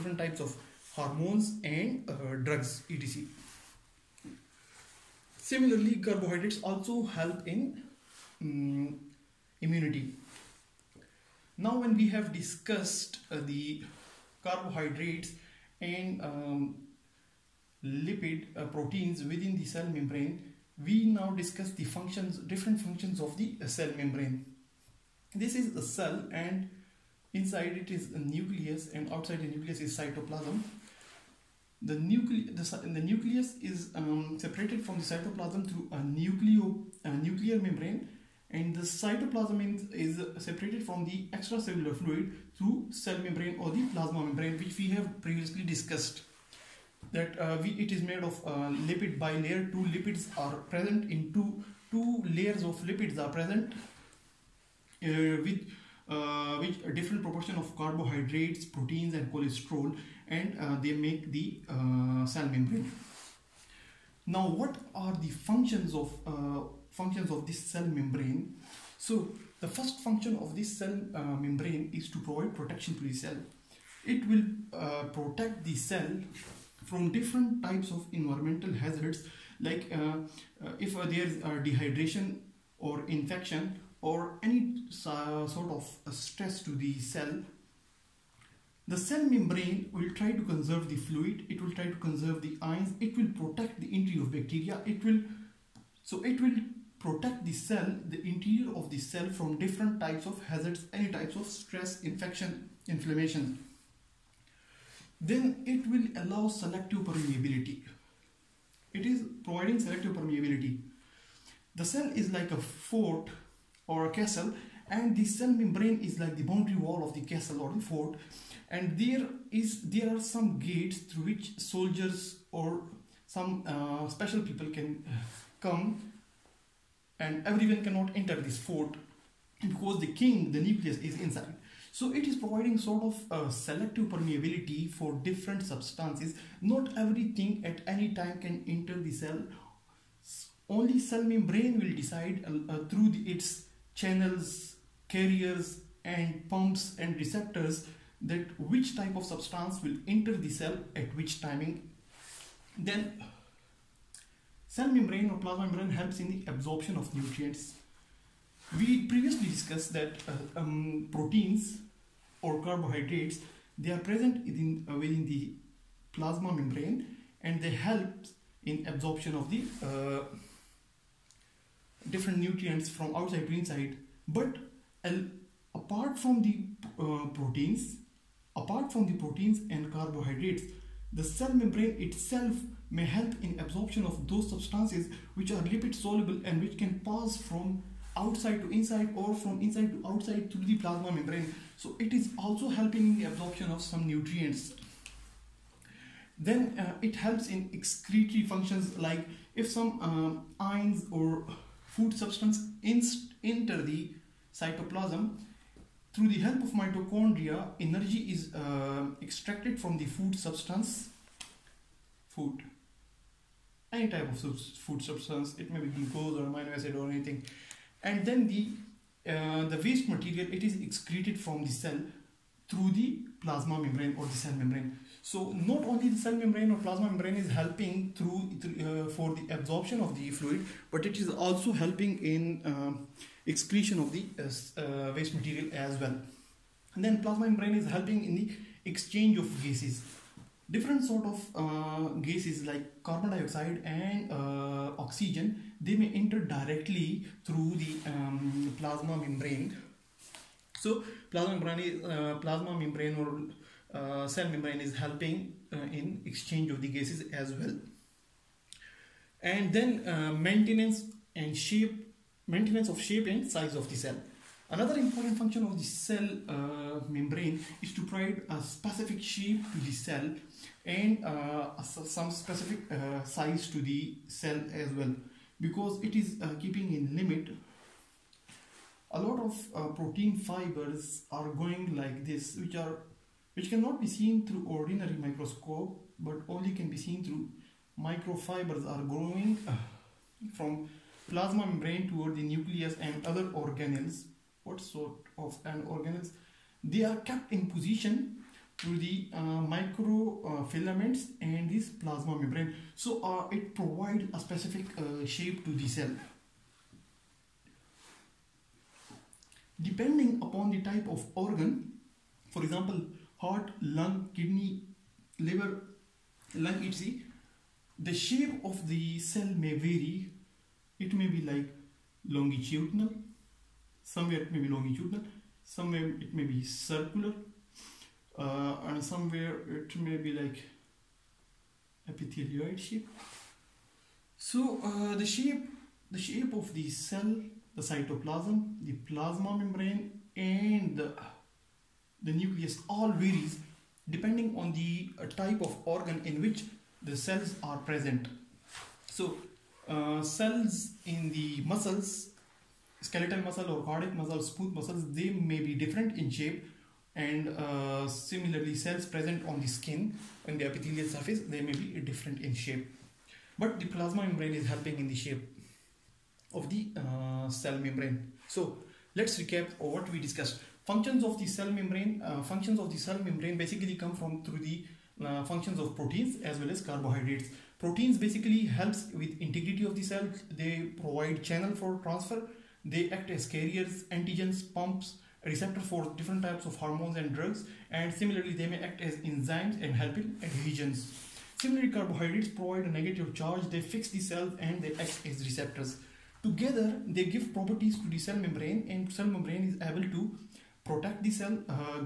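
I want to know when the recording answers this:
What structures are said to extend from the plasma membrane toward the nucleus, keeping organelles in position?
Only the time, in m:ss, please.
4:59.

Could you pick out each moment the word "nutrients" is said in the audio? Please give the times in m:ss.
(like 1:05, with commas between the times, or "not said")
2:37, 2:52, 3:14.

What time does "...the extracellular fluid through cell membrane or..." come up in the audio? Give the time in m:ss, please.
0:41.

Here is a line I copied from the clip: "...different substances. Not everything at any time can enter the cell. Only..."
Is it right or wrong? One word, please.
right.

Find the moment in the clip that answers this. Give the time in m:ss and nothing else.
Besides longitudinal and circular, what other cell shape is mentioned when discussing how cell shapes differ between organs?
5:32.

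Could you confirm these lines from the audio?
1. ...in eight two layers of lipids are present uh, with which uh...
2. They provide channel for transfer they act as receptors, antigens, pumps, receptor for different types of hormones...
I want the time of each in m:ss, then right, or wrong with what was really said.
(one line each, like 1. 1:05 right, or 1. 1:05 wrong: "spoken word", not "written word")
1. 0:51 wrong: "two", not "eight"
2. 6:20 wrong: "carriers", not "receptors".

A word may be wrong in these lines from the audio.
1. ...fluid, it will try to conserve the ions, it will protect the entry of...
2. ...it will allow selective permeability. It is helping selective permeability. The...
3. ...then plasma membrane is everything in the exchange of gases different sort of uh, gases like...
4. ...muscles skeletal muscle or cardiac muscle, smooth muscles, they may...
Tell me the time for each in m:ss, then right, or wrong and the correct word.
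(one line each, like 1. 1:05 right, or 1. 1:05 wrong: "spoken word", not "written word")
1. 1:30 right
2. 1:45 wrong: "providing", not "helping"
3. 3:57 wrong: "helping", not "everything"
4. 5:51 right.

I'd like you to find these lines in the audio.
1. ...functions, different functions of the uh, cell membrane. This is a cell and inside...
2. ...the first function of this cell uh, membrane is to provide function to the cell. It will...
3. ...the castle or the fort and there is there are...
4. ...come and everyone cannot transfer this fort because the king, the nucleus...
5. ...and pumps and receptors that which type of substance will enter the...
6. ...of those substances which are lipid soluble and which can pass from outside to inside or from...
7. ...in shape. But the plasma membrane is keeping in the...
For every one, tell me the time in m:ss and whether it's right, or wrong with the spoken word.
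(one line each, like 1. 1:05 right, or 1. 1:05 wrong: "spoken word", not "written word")
1. 0:21 right
2. 1:09 wrong: "protection", not "function"
3. 1:57 right
4. 2:05 wrong: "enter", not "transfer"
5. 2:26 right
6. 3:04 right
7. 6:02 wrong: "helping", not "keeping".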